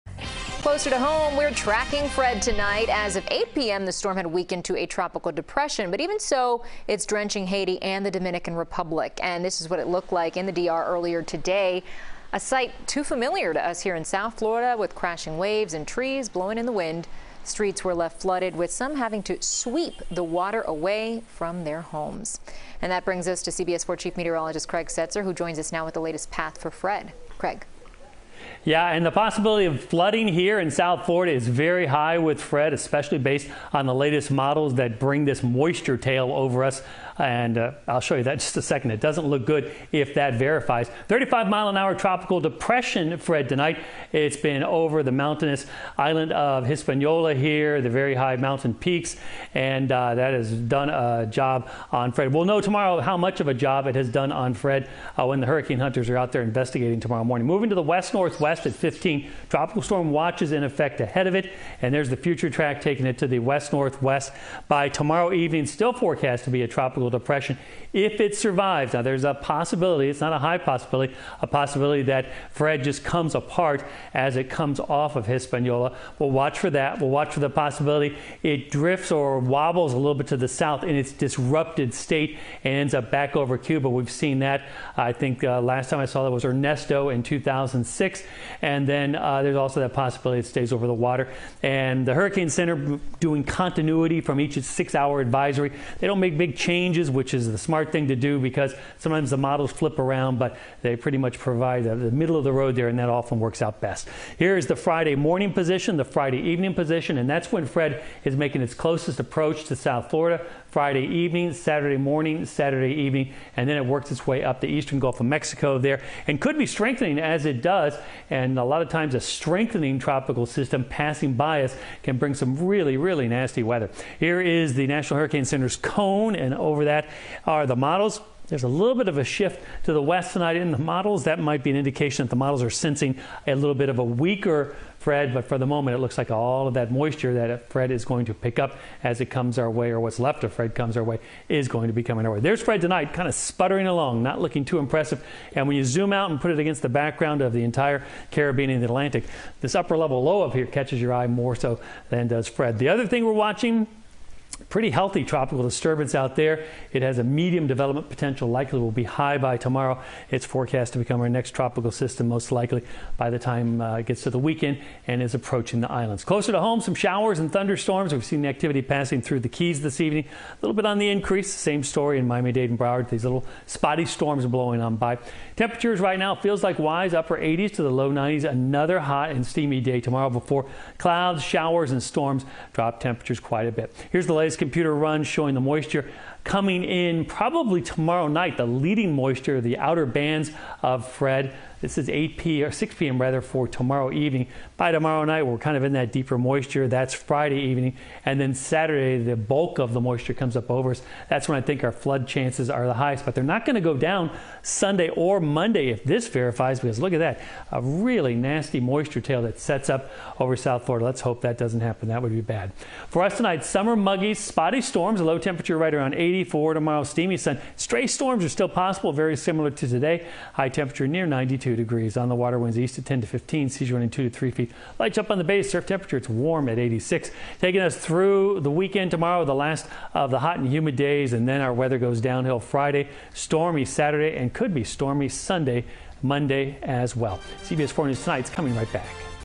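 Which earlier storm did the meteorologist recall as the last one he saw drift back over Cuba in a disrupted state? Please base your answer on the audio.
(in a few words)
Ernesto.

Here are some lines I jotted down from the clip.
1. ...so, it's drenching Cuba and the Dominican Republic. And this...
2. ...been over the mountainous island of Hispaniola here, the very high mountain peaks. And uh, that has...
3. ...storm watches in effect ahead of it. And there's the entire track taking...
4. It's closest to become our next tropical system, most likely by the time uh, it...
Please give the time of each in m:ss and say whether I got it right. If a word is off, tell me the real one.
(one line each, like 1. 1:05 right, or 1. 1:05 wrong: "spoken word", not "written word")
1. 0:06 wrong: "Haiti", not "Cuba"
2. 0:44 right
3. 0:59 wrong: "future", not "entire"
4. 2:40 wrong: "forecast", not "closest".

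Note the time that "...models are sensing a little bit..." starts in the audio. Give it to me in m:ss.
2:12.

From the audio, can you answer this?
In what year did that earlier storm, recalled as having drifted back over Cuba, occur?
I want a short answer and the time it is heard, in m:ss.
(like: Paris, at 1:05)
2006, at 1:27.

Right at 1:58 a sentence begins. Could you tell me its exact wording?
And a lot of times, a strengthening tropical system passing by us can bring some really, really nasty weather.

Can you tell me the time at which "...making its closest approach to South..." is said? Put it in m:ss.
1:48.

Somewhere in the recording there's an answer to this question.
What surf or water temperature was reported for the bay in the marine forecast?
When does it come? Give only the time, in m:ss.
3:46.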